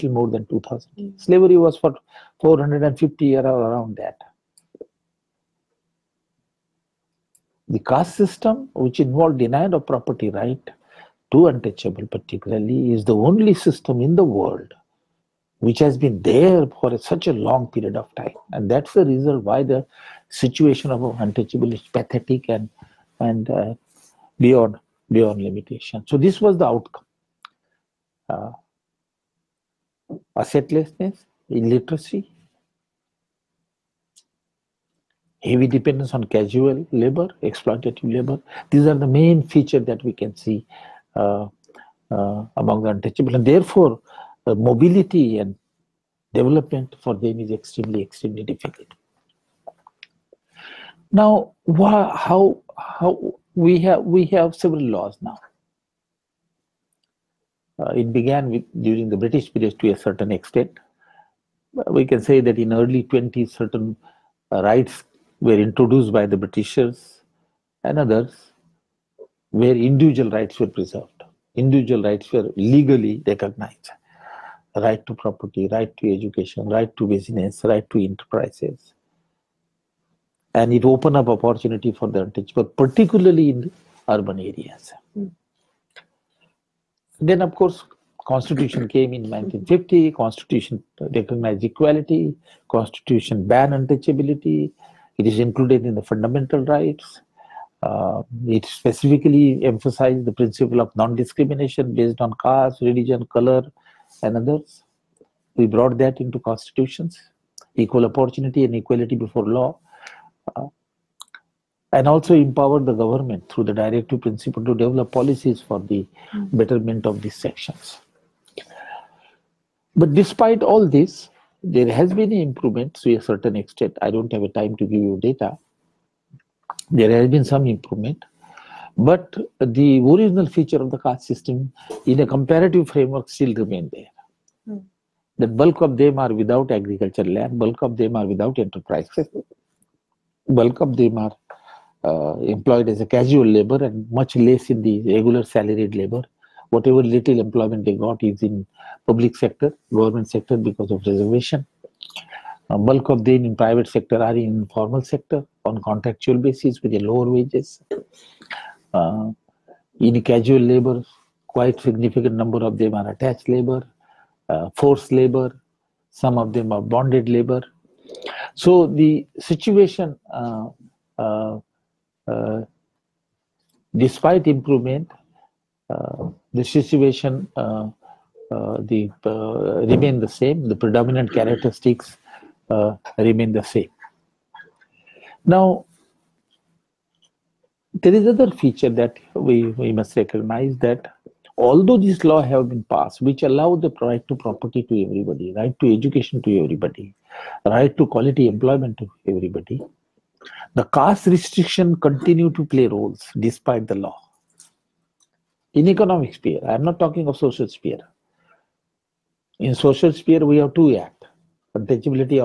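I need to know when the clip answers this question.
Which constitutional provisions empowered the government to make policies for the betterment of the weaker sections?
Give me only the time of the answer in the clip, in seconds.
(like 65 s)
113 s.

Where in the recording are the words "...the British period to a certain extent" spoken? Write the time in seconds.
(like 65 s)
59 s.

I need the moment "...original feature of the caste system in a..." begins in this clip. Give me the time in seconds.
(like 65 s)
130 s.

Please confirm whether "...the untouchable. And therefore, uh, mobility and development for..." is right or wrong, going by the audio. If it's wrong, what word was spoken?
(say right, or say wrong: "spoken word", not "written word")
right.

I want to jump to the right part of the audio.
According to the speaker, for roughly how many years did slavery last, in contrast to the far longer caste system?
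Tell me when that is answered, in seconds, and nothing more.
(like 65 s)
2 s.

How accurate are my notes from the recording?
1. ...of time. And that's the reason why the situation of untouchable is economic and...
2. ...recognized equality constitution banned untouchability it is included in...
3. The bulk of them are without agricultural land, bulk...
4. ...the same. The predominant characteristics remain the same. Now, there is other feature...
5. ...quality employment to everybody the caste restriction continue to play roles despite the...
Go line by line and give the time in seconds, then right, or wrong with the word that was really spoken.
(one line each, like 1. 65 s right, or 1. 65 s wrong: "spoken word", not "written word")
1. 17 s wrong: "pathetic", not "economic"
2. 91 s right
3. 135 s right
4. 180 s right
5. 198 s right.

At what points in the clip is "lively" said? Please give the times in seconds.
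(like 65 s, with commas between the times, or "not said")
not said.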